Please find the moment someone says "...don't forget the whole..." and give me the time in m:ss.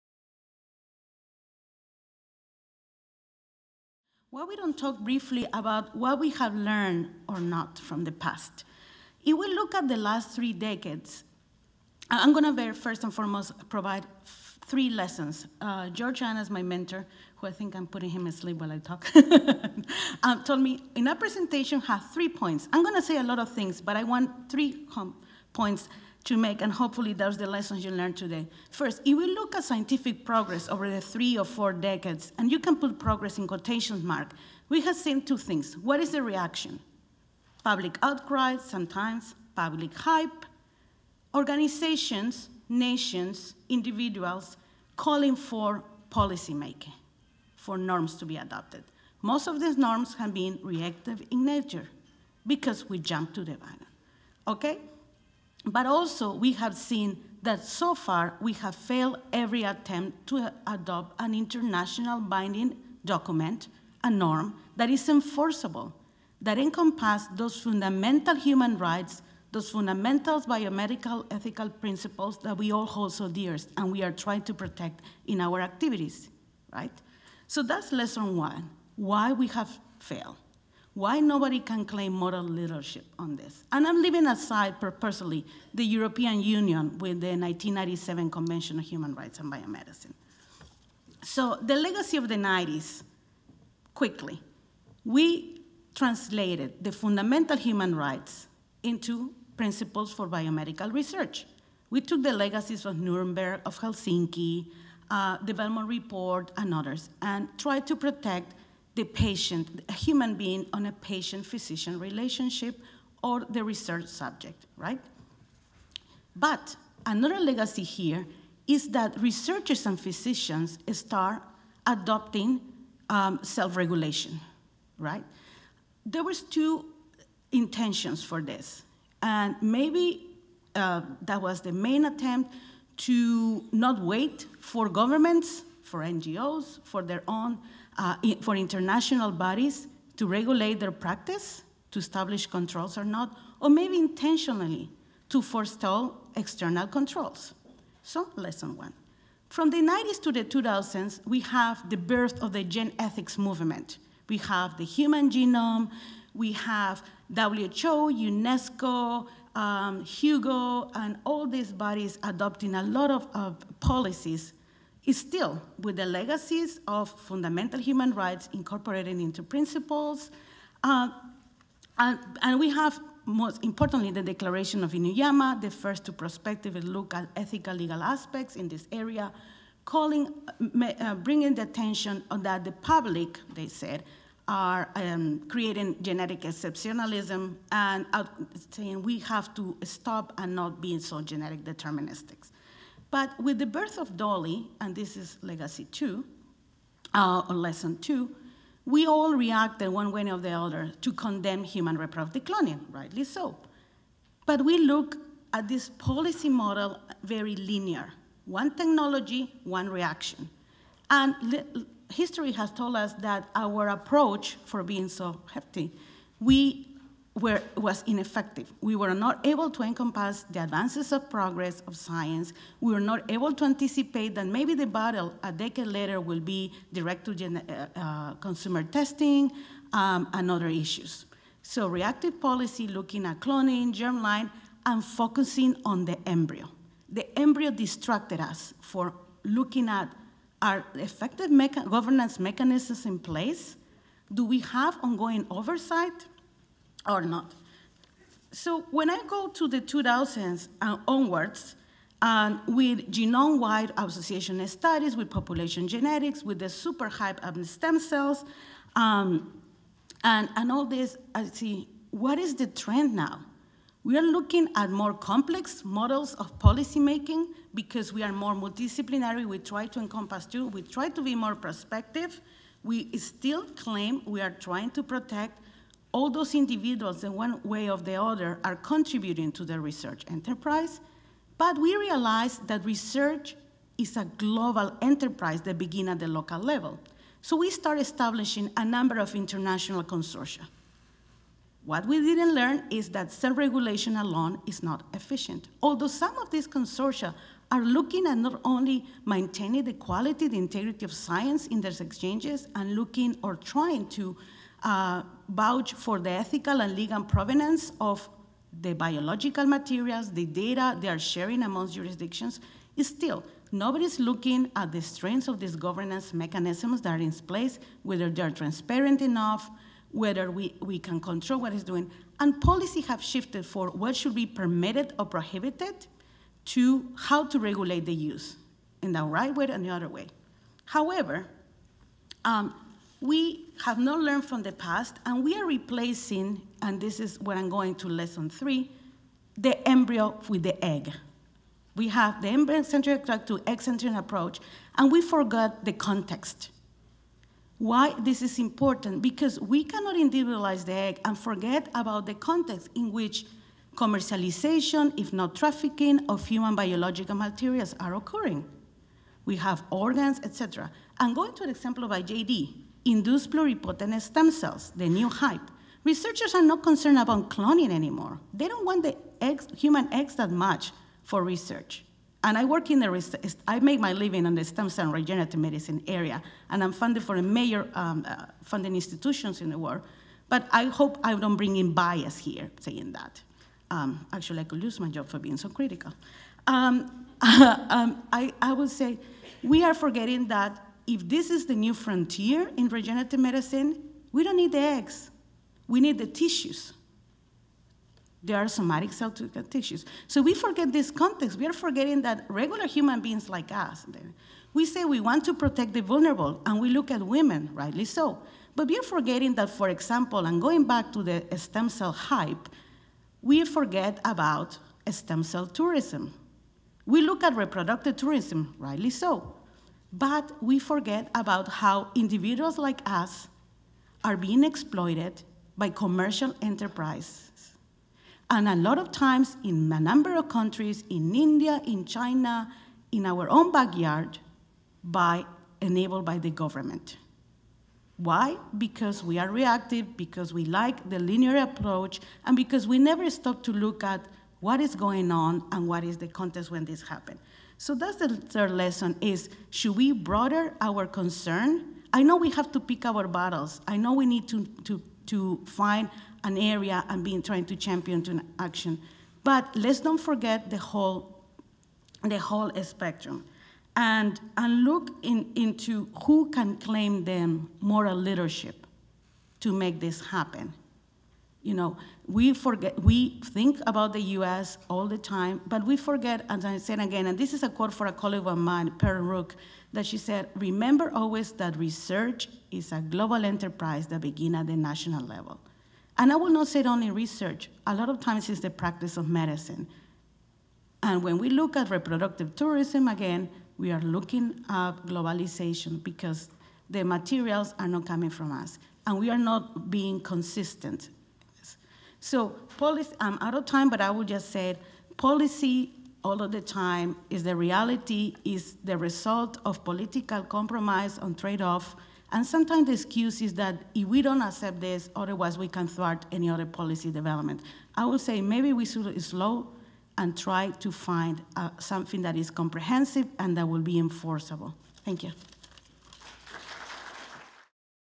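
7:39.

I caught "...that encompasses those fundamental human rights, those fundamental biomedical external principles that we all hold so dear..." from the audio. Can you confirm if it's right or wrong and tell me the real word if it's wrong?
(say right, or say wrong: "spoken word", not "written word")
wrong: "ethical", not "external".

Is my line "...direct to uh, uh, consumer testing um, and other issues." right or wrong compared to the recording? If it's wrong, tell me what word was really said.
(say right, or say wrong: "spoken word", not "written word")
right.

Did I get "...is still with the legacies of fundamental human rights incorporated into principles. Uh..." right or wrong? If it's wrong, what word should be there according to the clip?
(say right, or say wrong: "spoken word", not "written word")
right.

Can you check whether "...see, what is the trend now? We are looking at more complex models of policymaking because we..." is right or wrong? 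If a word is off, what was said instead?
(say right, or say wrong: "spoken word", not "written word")
right.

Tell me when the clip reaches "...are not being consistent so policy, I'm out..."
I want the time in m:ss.
8:19.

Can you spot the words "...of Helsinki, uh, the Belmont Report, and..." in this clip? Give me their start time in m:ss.
1:43.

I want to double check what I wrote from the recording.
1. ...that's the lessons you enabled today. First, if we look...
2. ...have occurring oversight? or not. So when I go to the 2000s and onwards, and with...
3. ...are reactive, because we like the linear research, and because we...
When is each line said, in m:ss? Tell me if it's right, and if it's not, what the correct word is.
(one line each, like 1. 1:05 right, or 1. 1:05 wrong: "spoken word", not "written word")
1. 0:27 wrong: "learned", not "enabled"
2. 4:04 wrong: "ongoing", not "occurring"
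3. 7:19 wrong: "approach", not "research".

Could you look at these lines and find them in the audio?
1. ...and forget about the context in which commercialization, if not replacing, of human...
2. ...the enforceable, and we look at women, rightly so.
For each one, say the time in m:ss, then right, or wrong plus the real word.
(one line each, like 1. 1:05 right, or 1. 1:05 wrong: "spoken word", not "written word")
1. 5:51 wrong: "trafficking", not "replacing"
2. 6:45 wrong: "vulnerable", not "enforceable".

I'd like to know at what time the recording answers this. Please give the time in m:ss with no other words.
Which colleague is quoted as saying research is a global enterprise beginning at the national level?
7:58.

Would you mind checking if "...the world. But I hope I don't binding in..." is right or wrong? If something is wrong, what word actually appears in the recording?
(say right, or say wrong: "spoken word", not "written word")
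wrong: "bring", not "binding".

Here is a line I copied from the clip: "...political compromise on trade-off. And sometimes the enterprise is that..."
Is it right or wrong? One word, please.
wrong.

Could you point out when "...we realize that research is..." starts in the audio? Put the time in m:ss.
4:41.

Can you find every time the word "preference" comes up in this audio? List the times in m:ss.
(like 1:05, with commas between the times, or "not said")
not said.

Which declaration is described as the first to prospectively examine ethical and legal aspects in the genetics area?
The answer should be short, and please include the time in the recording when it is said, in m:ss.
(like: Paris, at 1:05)
Declaration of Inuyama, at 2:54.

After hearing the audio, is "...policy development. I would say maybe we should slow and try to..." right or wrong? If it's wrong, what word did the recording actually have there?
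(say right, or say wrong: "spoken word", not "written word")
right.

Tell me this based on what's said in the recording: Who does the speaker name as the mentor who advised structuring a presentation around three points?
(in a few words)
George Annas.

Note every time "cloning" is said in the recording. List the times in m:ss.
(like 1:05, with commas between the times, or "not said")
3:22, 3:53, 6:07.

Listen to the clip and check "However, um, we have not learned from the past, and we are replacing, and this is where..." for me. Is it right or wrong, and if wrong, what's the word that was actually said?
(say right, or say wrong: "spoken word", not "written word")
right.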